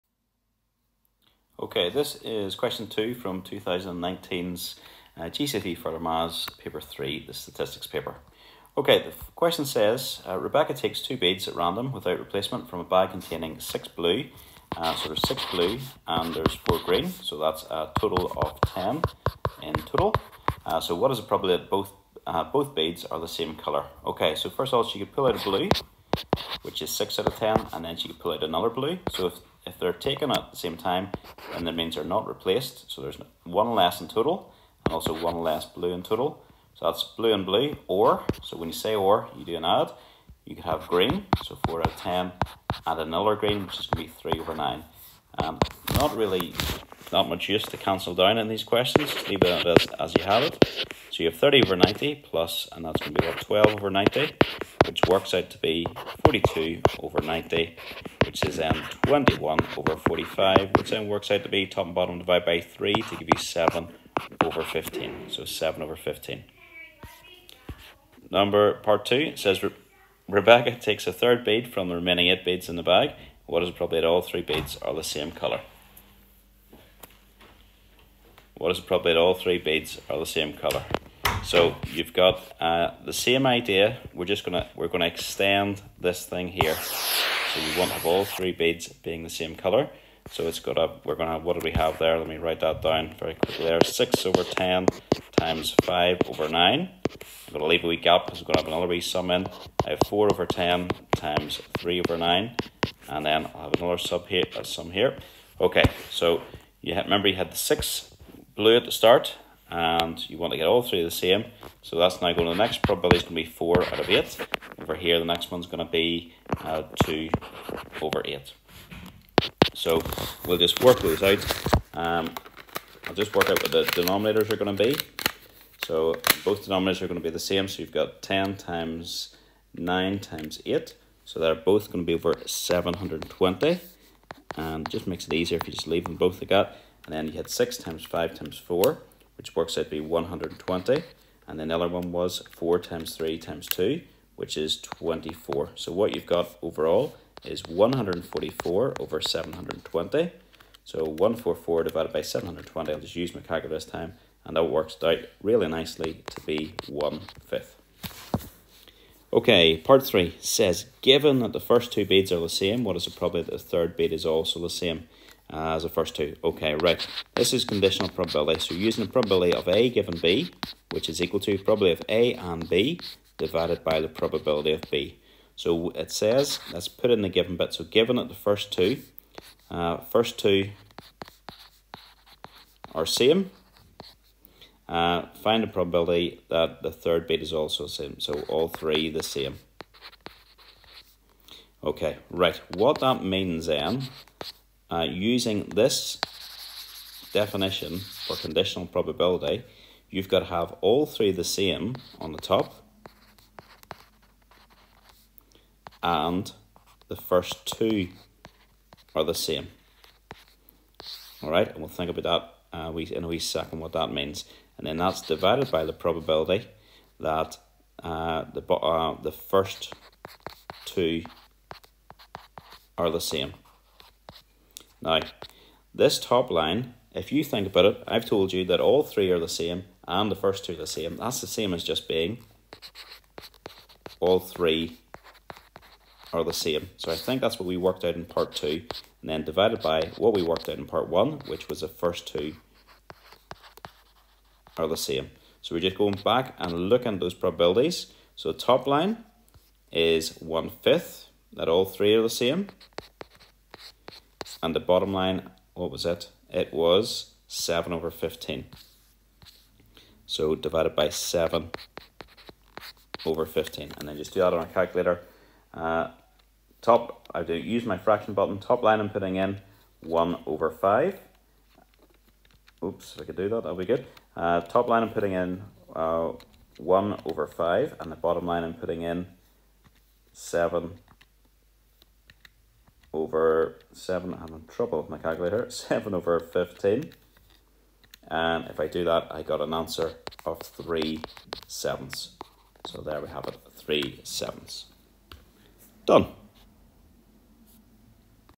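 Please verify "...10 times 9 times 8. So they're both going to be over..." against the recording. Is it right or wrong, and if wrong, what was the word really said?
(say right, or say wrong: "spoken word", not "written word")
right.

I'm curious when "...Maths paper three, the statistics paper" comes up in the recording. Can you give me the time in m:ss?
0:05.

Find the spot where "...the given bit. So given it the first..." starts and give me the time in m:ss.
2:57.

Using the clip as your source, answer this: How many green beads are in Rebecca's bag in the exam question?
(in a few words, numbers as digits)
4.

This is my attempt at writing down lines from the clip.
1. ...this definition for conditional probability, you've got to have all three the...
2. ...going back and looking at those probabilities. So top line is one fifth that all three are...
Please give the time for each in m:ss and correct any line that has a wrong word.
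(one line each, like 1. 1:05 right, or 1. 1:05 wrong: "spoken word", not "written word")
1. 3:15 right
2. 4:05 right.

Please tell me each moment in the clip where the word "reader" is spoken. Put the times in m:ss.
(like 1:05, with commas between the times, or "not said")
not said.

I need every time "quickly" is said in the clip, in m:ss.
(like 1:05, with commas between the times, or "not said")
1:33.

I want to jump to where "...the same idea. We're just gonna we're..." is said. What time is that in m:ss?
1:23.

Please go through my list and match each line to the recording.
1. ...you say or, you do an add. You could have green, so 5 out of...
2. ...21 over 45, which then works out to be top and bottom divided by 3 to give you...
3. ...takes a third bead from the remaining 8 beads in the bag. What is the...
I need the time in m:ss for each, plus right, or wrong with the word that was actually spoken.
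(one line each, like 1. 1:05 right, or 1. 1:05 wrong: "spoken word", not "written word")
1. 0:38 wrong: "4", not "5"
2. 0:59 right
3. 1:10 right.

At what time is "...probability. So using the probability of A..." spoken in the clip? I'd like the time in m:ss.
2:48.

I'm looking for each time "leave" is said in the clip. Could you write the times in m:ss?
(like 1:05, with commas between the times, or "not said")
0:49, 1:37, 2:15.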